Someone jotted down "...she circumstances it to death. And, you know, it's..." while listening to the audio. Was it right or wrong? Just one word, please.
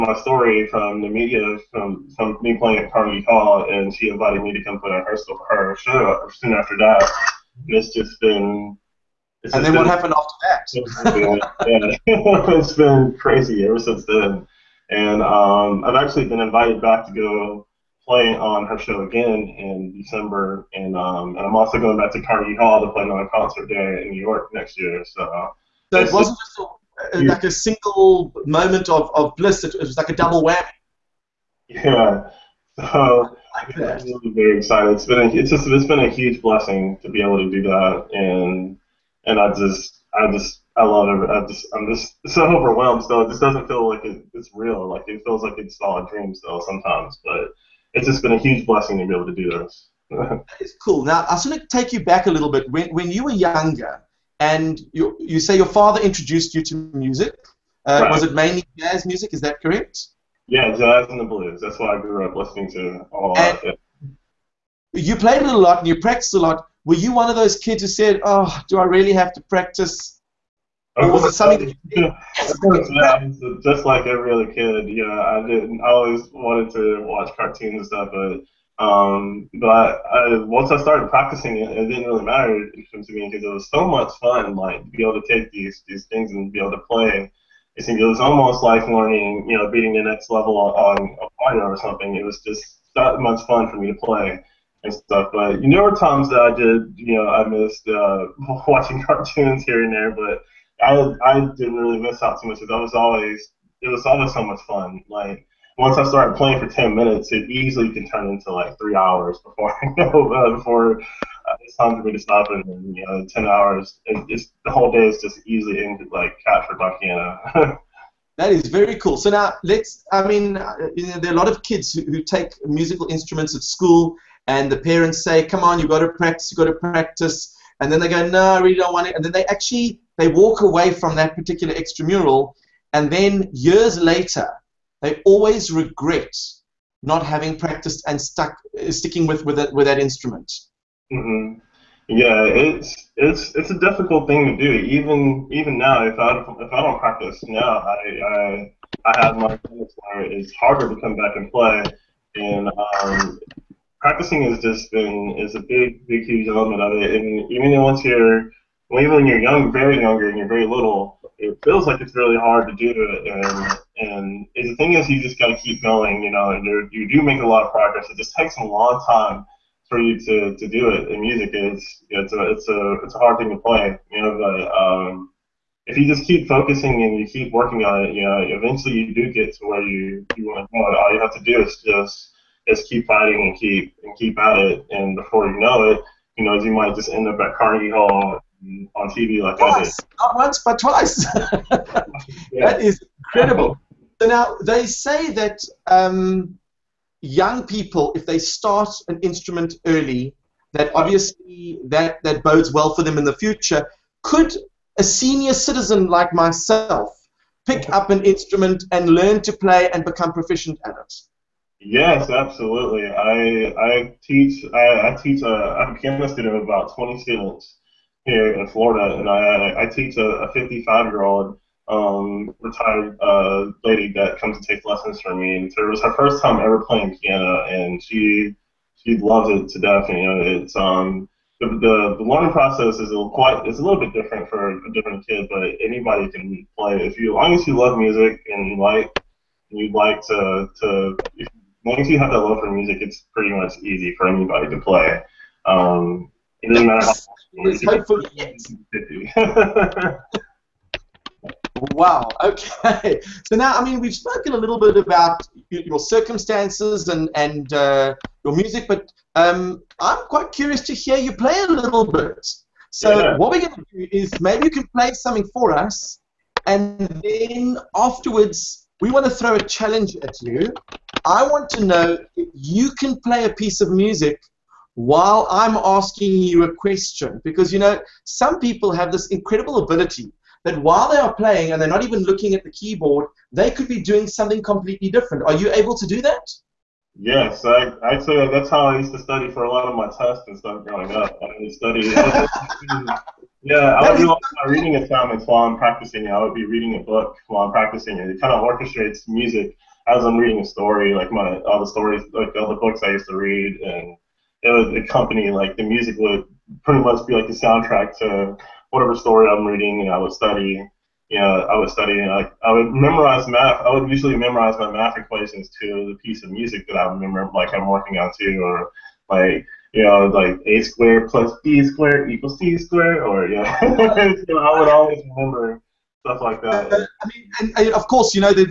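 wrong.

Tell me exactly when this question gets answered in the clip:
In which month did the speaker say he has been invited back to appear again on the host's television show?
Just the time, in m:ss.
0:19.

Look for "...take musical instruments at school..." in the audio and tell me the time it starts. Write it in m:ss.
2:02.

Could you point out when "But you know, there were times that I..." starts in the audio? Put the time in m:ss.
1:35.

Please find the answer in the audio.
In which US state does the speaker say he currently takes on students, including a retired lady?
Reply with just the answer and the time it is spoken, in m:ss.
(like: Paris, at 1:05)
Florida, at 3:38.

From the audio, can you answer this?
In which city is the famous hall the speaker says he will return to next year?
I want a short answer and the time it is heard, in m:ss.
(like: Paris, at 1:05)
New York, at 0:24.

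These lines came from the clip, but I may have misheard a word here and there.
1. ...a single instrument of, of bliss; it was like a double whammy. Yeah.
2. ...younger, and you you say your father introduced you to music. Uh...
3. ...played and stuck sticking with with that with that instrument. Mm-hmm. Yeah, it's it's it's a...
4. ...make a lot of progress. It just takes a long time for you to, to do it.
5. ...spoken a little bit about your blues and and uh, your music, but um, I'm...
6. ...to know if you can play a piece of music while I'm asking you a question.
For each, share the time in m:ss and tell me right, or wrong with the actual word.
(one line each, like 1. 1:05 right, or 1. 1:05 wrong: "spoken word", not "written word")
1. 0:27 wrong: "moment", not "instrument"
2. 0:53 right
3. 2:17 wrong: "practiced", not "played"
4. 2:47 right
5. 4:14 wrong: "circumstances", not "blues"
6. 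4:31 right.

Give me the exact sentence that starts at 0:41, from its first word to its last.
I'm just, I'm just so overwhelmed.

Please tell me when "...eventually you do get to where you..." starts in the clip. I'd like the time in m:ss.
2:58.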